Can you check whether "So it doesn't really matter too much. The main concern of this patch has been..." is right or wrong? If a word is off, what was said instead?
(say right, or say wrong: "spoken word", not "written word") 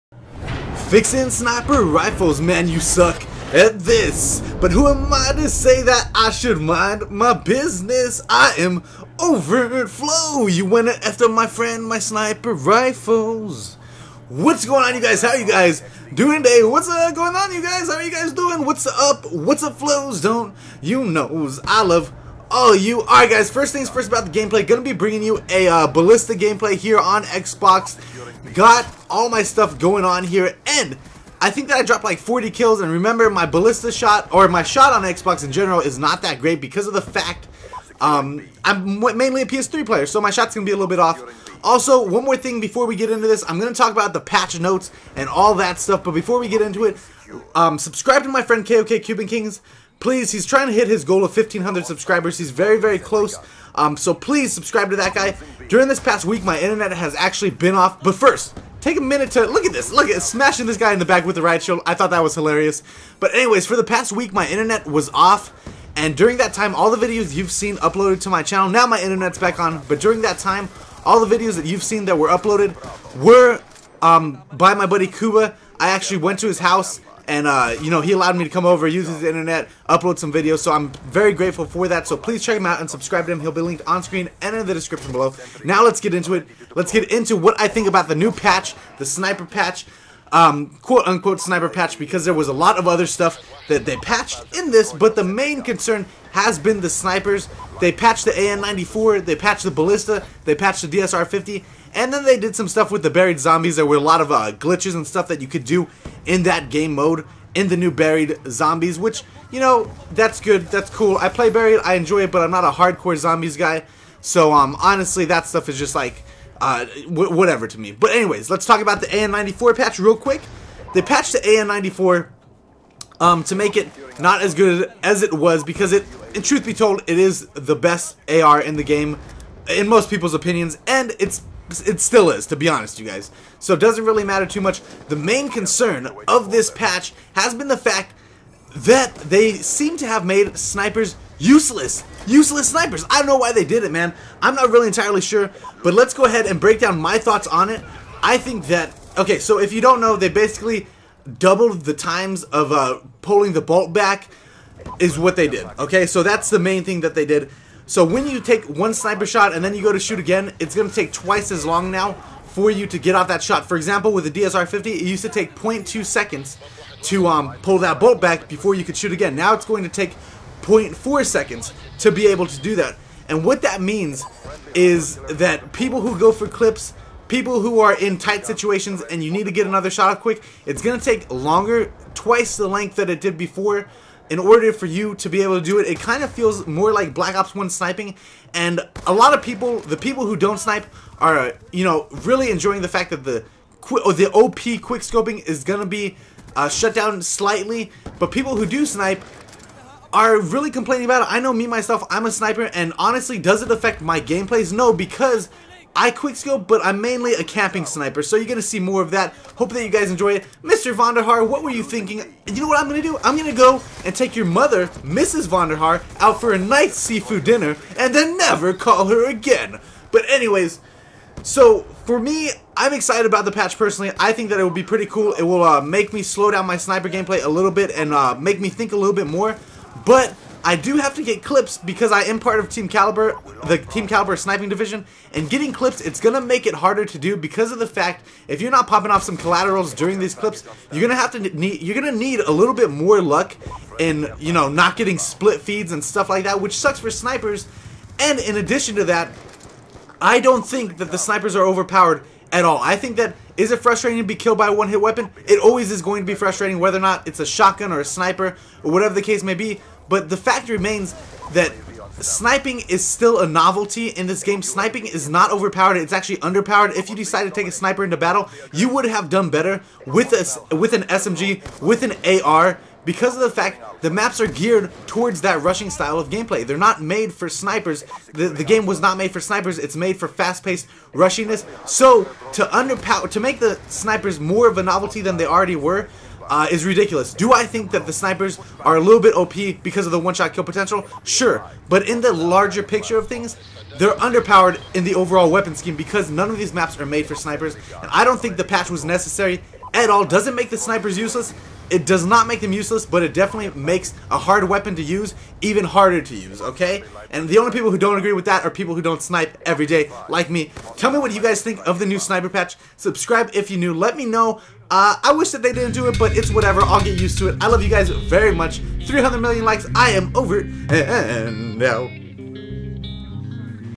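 right.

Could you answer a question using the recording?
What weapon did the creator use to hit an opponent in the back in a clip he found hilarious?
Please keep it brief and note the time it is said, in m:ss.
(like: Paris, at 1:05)
riot shield, at 1:01.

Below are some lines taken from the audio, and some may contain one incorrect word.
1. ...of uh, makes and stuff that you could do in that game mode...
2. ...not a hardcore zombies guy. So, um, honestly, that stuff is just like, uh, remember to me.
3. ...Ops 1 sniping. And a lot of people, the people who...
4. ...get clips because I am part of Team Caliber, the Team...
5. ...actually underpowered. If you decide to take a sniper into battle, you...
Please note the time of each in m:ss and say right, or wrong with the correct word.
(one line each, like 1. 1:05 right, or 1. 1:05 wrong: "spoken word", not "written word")
1. 1:44 wrong: "glitches", not "makes"
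2. 1:52 wrong: "whatever", not "remember"
3. 3:07 right
4. 3:51 right
5. 4:26 right.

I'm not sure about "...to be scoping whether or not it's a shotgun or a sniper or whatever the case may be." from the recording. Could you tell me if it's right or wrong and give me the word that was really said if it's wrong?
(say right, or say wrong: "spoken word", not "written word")
wrong: "frustrating", not "scoping".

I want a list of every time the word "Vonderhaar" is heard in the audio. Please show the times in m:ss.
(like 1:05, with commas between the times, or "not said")
3:30, 3:35.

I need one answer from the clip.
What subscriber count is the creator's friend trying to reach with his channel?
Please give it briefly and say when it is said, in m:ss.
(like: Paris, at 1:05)
1,500, at 0:51.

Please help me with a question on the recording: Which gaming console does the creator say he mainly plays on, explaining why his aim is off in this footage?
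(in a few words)
PS3.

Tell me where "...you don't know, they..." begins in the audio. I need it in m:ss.
2:29.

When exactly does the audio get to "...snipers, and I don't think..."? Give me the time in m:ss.
4:57.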